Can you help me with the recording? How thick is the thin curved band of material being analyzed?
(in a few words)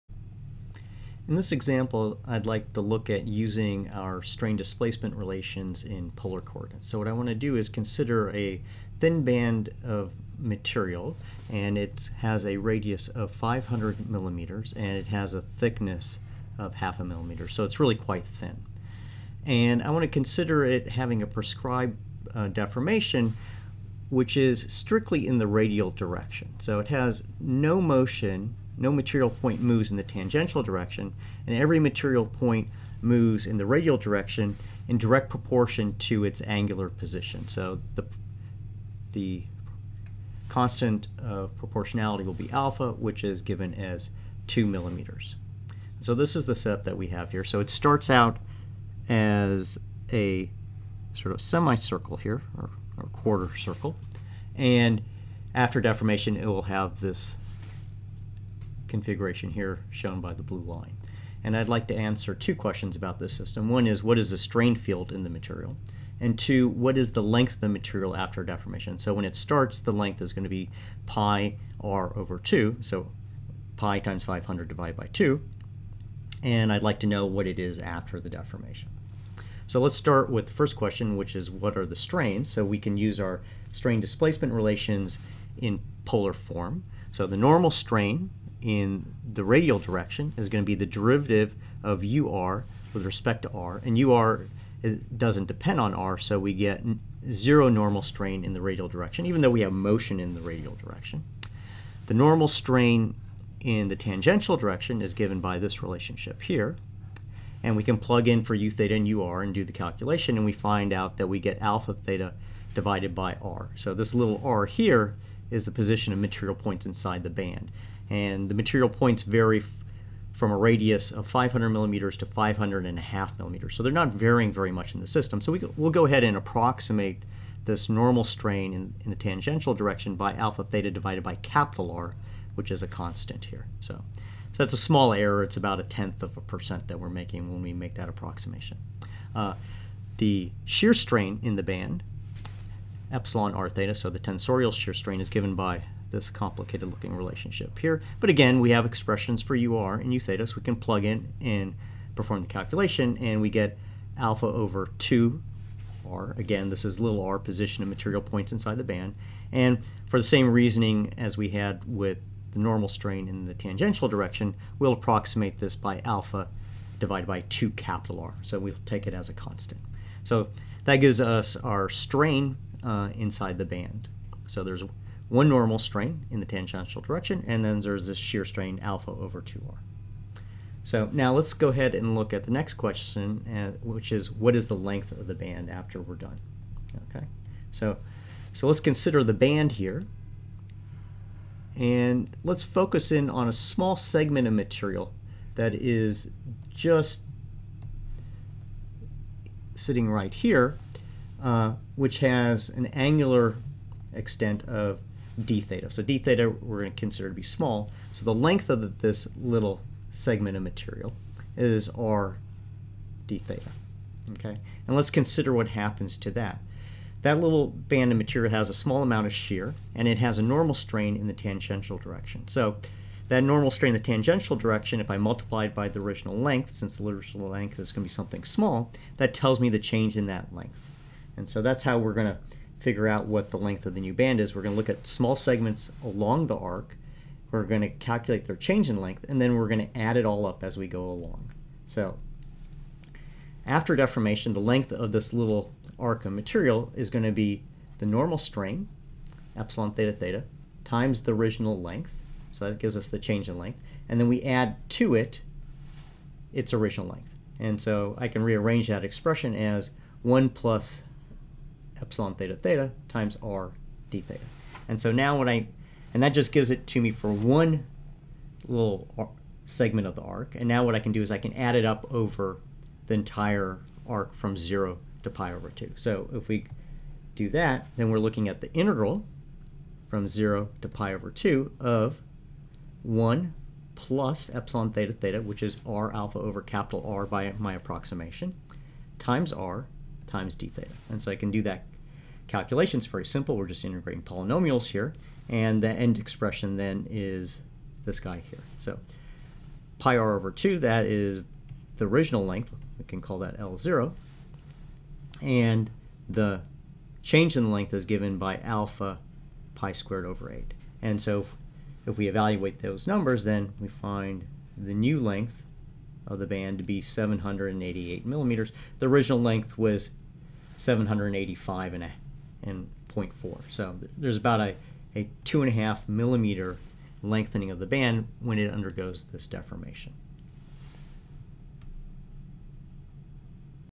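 half a millimeter.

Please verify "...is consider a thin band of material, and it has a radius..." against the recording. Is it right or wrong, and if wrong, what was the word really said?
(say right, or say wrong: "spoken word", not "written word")
right.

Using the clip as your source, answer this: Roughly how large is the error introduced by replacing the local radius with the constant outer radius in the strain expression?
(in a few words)
a tenth of a percent.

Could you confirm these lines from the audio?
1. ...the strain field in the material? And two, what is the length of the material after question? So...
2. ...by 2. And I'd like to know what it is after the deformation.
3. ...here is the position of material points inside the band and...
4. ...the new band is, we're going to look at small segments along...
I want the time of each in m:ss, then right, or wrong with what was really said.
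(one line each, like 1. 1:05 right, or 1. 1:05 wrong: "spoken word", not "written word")
1. 1:04 wrong: "deformation", not "question"
2. 1:14 right
3. 1:54 right
4. 3:53 right.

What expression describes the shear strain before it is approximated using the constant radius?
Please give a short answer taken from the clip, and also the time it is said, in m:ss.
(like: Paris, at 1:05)
alpha over 2r, at 2:34.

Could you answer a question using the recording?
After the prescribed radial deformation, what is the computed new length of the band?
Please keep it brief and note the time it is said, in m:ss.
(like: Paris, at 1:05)
788 millimeters, at 5:17.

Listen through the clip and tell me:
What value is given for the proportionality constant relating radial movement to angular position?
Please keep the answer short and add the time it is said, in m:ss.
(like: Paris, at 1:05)
2 millimeters, at 0:44.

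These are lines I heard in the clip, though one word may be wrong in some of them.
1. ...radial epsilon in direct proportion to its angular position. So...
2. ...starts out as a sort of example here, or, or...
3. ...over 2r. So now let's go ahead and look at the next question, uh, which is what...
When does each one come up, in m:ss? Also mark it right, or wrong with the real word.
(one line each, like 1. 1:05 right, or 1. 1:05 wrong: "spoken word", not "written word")
1. 0:33 wrong: "direction", not "epsilon"
2. 0:47 wrong: "semicircle", not "example"
3. 2:59 right.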